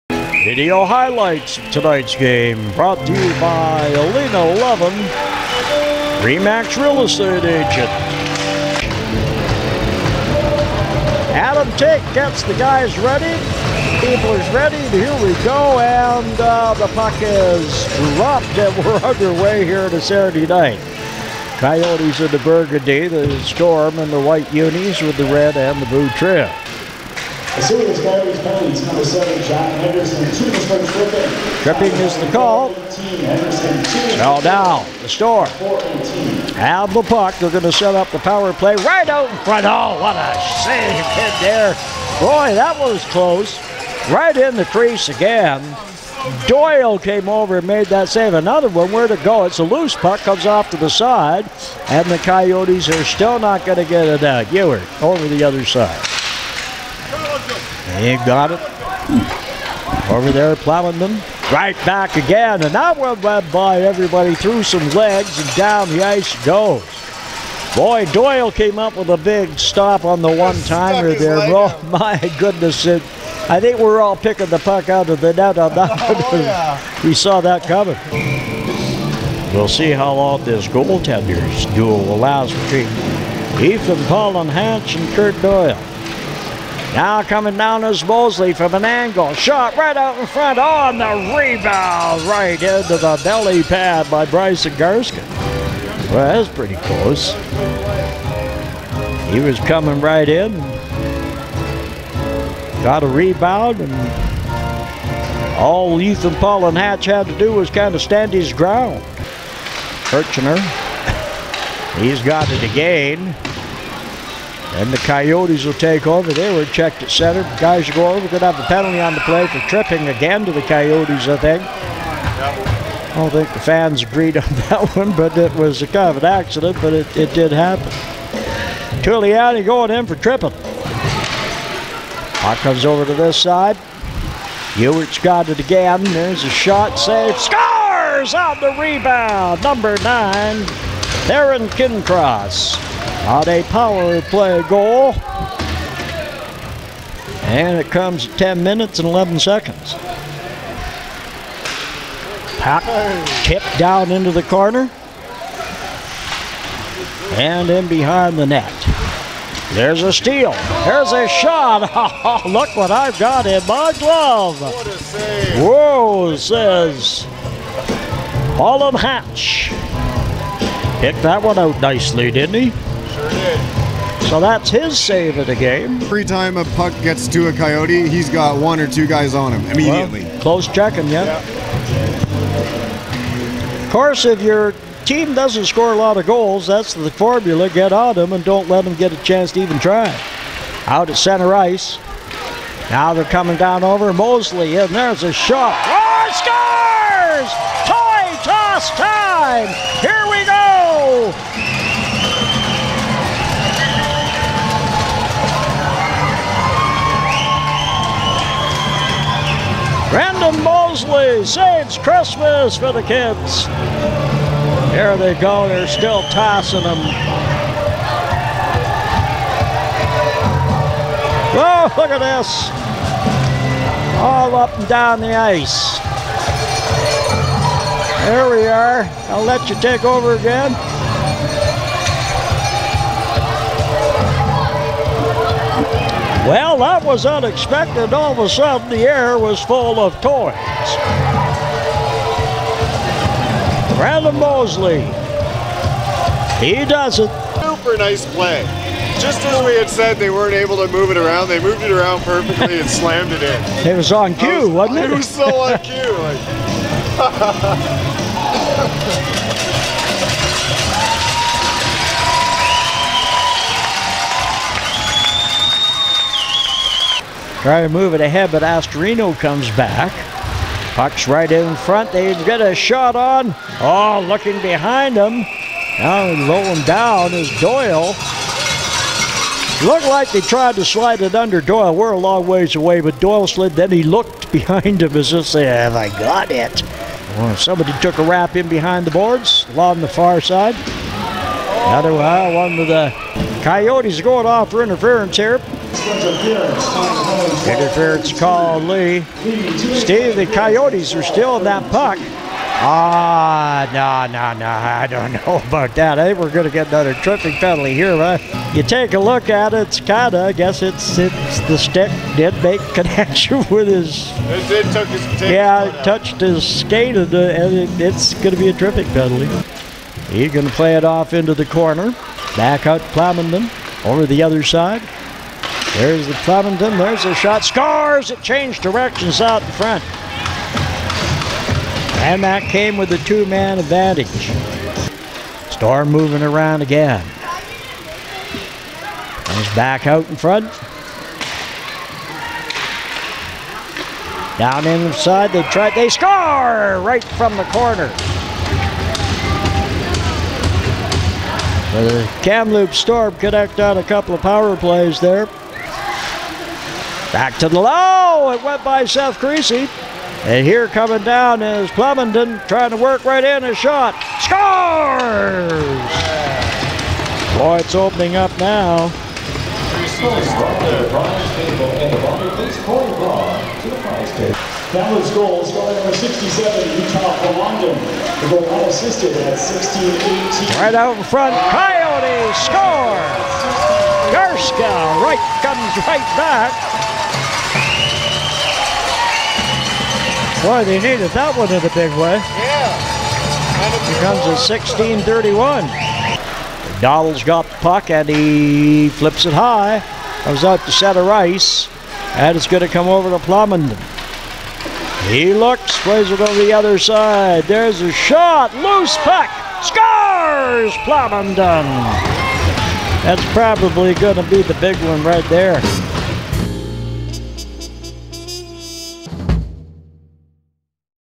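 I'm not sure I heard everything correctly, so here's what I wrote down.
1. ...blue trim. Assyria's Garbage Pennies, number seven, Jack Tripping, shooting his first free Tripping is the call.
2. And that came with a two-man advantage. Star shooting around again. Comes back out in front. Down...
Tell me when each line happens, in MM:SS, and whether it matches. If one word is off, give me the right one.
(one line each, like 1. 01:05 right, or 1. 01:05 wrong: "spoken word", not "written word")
1. 00:25 wrong: "Henderson", not "Tripping"
2. 05:32 wrong: "moving", not "shooting".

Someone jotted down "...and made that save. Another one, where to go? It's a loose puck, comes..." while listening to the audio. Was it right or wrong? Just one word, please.
right.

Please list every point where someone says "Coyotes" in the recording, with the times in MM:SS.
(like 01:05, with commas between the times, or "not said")
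00:21, 00:52, 01:54, 02:00, 02:57, 04:53, 05:00, 06:21.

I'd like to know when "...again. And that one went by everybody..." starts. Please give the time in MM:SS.
01:02.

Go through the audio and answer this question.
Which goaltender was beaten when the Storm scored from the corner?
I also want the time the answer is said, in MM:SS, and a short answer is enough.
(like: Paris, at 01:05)
Seth Creasy, at 05:59.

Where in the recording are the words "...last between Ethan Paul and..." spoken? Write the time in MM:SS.
01:22.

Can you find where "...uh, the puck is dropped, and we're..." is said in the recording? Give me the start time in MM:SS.
00:16.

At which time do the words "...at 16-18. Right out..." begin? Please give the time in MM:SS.
06:19.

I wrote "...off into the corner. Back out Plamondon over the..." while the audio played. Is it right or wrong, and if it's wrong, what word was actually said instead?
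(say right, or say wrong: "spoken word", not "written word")
right.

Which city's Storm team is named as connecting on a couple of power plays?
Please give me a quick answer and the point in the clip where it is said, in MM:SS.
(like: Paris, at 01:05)
Kamloops, at 05:52.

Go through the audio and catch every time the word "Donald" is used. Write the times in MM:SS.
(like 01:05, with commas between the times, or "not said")
06:37.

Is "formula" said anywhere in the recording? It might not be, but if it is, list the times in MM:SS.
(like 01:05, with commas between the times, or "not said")
03:07.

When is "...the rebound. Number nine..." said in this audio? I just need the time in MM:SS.
02:18.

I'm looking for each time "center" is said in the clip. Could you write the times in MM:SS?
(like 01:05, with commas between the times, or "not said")
01:57, 03:11.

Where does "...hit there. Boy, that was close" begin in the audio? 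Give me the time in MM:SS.
00:41.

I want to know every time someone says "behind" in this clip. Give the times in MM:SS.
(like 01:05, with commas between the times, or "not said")
02:37, 04:34, 04:44, 04:48.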